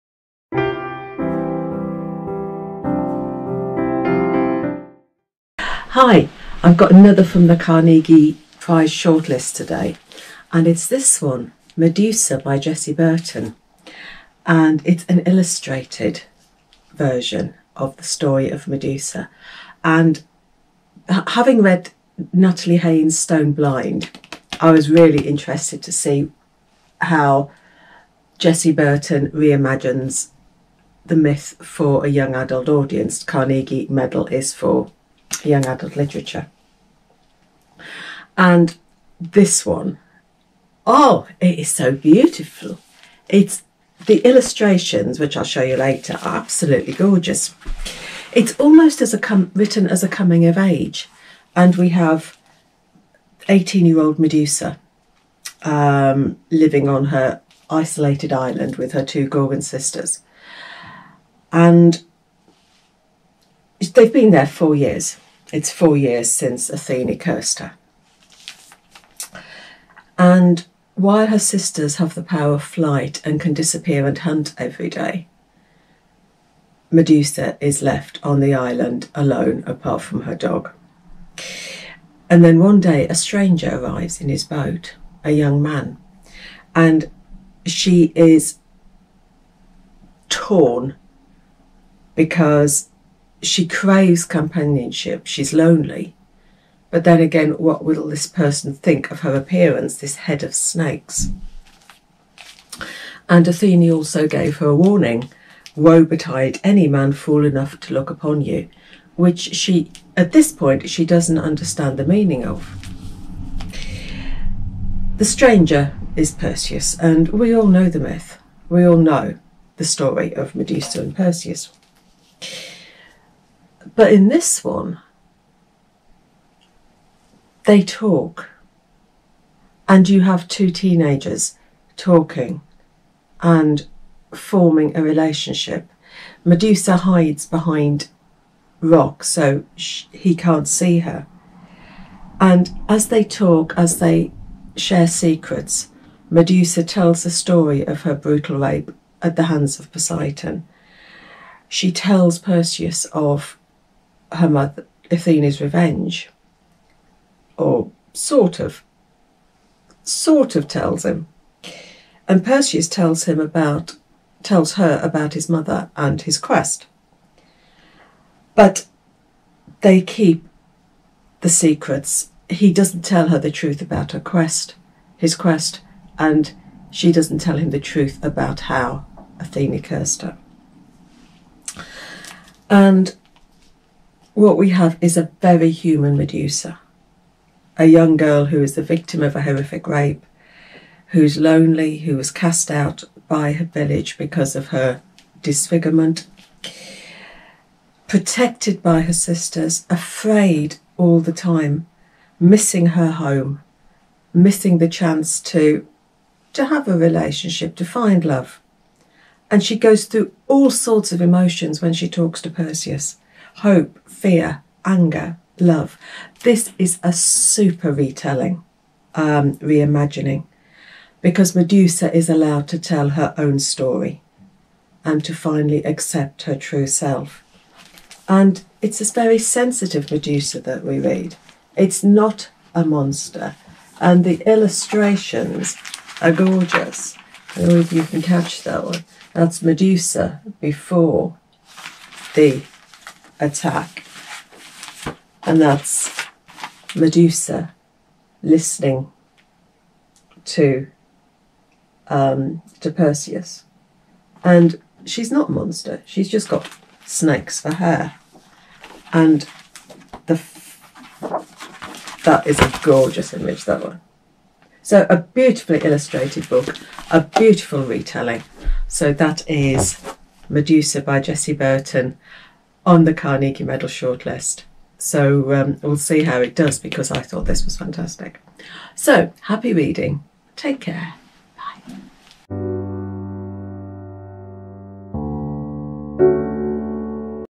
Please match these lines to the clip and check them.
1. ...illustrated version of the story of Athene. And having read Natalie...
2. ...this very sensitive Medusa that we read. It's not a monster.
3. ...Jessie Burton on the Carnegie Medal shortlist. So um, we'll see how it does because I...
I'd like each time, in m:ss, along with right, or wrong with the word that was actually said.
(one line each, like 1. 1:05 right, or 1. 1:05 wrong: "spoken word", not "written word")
1. 0:15 wrong: "Medusa", not "Athene"
2. 3:48 right
3. 4:31 right.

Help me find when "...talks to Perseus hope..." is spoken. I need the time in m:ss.
3:32.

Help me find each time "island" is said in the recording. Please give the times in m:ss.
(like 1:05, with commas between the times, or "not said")
0:58, 1:18.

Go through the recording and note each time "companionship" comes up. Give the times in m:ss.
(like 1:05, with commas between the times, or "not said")
1:34.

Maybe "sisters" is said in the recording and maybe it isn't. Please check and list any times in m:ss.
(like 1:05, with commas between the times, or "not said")
0:59, 1:11, 3:19.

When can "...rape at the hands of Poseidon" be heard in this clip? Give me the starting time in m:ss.
2:28.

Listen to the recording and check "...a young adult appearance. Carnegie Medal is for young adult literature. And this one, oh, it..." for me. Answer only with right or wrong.
wrong.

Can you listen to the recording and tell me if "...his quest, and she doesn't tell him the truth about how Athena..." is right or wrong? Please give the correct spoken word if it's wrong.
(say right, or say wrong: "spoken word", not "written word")
right.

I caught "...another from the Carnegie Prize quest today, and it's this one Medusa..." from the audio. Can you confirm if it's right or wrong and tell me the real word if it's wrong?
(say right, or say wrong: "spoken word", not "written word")
wrong: "shortlist", not "quest".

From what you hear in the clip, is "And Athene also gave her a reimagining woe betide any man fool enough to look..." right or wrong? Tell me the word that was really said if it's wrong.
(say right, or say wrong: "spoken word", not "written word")
wrong: "warning", not "reimagining".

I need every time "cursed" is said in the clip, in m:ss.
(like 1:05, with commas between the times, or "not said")
1:07, 2:59.